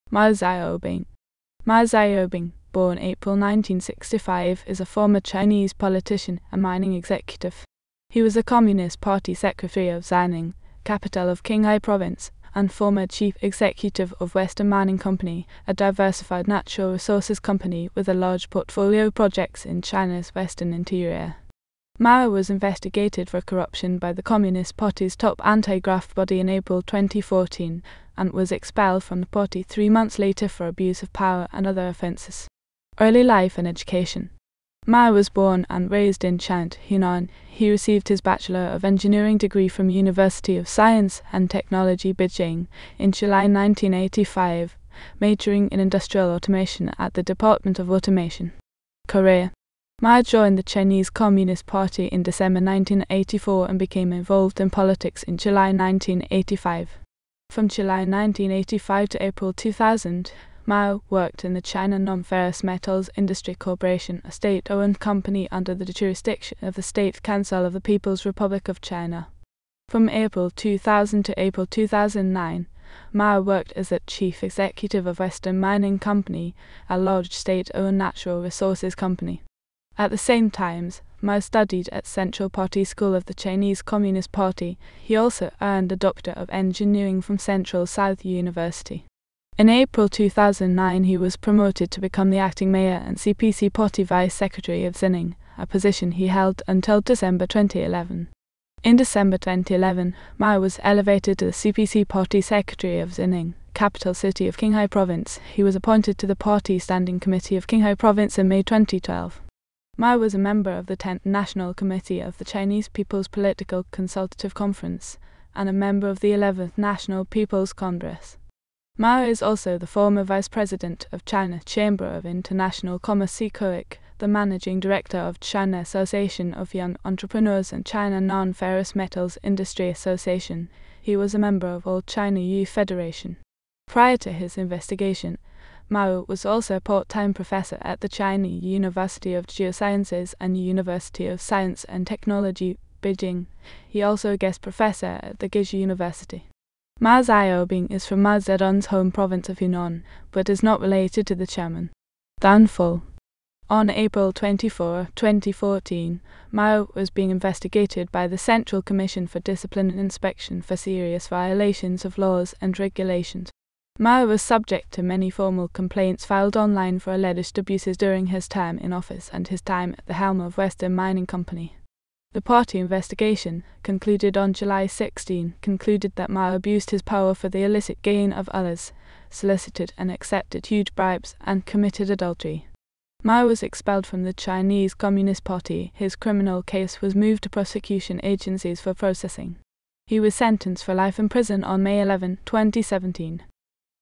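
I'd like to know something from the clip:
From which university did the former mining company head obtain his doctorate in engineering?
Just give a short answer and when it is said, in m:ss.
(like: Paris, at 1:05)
Central South University, at 1:27.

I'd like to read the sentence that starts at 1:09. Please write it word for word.
From April 2000 to April 2009, Mao worked as the chief executive of Western Mining Company, a large state-owned natural resources company.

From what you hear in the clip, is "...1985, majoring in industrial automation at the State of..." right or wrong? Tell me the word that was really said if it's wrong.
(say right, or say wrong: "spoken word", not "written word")
wrong: "Department", not "State".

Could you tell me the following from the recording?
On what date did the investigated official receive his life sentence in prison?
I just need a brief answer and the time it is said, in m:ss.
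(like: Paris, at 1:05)
May 11, 2017, at 3:11.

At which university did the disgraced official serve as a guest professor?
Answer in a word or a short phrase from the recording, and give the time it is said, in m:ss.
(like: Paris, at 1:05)
Guizhou University, at 2:25.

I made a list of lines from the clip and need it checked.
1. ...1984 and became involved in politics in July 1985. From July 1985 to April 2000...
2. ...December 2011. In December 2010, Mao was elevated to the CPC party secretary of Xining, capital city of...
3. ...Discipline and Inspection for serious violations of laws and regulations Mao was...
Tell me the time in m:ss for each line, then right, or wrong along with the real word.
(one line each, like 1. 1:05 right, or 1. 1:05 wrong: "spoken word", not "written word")
1. 0:52 right
2. 1:37 wrong: "2011", not "2010"
3. 2:39 right.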